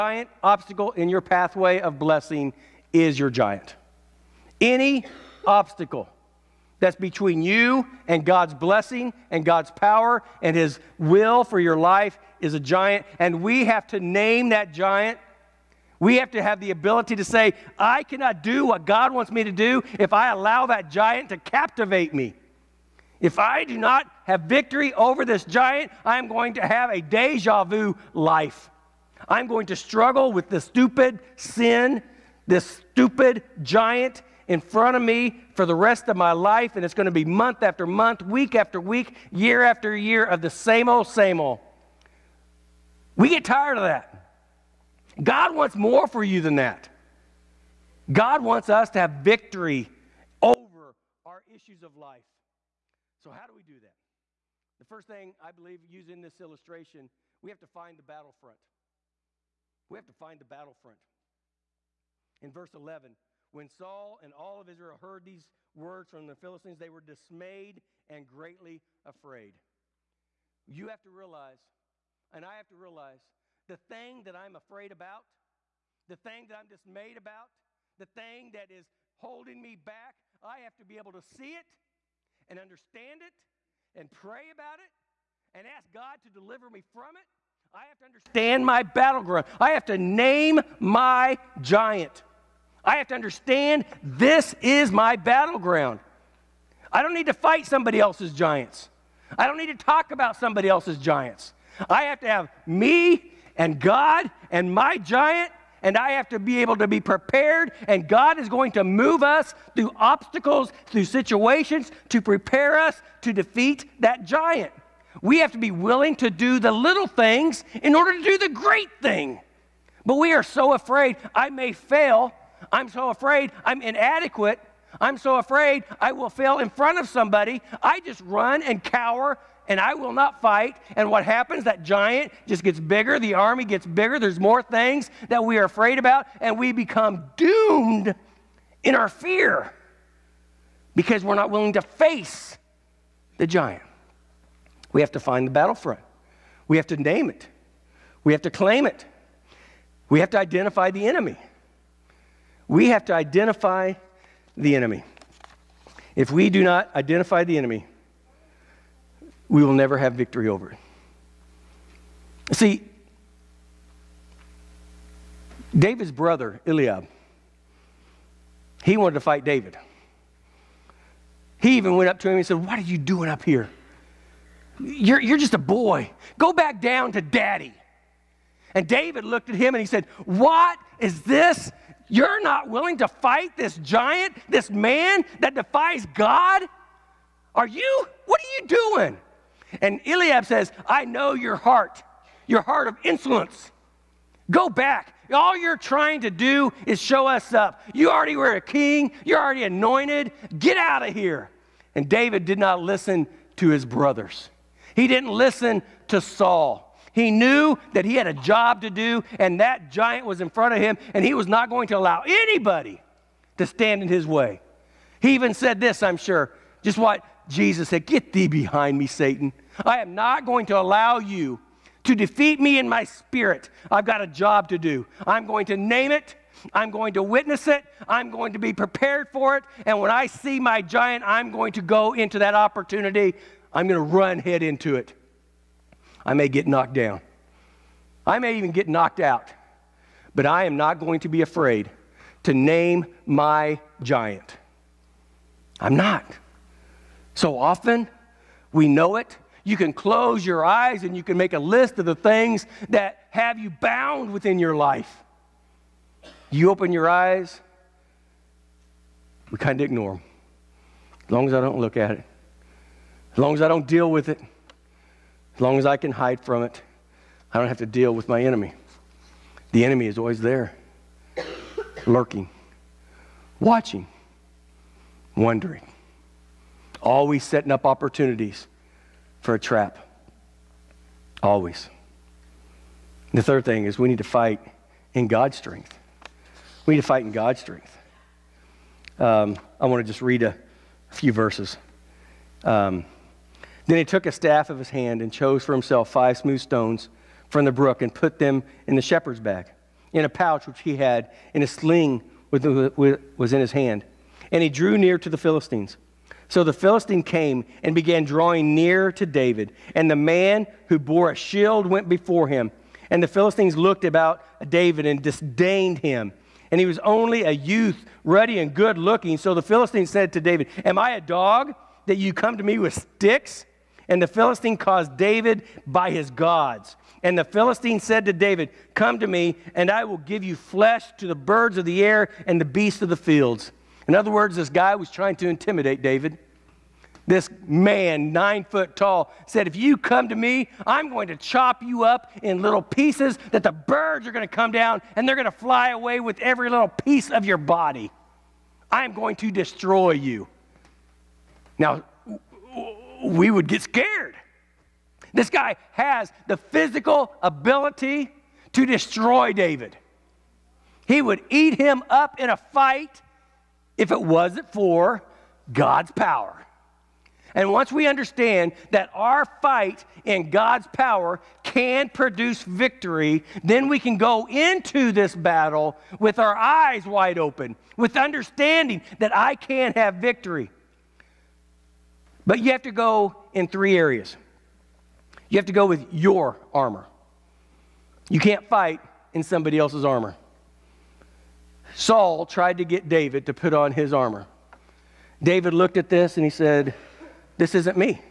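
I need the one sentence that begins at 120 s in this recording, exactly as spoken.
But we are so afraid I may fail.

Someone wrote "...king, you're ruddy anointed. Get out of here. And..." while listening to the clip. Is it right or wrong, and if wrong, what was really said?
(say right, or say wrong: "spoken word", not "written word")
wrong: "already", not "ruddy".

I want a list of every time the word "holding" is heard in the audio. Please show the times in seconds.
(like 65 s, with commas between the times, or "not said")
79 s.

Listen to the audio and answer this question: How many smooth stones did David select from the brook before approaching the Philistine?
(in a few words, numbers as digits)
5.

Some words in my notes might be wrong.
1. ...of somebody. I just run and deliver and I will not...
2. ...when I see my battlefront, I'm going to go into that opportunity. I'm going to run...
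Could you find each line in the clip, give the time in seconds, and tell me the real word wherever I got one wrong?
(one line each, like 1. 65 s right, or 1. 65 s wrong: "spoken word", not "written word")
1. 126 s wrong: "cower", not "deliver"
2. 229 s wrong: "giant", not "battlefront".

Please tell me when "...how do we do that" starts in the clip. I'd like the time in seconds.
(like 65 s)
53 s.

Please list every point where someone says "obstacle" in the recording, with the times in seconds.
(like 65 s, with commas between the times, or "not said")
0 s, 5 s, 109 s.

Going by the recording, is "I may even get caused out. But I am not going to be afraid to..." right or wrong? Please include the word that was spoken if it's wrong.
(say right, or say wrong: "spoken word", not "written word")
wrong: "knocked", not "caused".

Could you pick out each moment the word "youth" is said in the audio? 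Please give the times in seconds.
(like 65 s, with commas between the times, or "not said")
317 s.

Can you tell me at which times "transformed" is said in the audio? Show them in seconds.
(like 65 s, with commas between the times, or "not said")
not said.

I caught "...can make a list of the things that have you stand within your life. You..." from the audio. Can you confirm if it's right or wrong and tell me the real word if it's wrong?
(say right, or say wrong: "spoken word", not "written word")
wrong: "bound", not "stand".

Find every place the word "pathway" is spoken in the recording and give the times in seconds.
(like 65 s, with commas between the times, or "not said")
1 s.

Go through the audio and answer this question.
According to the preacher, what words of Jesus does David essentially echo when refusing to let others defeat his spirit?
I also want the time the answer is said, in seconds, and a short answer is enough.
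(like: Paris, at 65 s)
Get thee behind me, Satan, at 218 s.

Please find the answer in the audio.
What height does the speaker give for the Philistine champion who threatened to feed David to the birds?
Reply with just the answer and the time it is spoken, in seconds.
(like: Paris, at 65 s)
9 feet, at 338 s.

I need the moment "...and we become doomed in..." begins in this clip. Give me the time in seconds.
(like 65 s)
136 s.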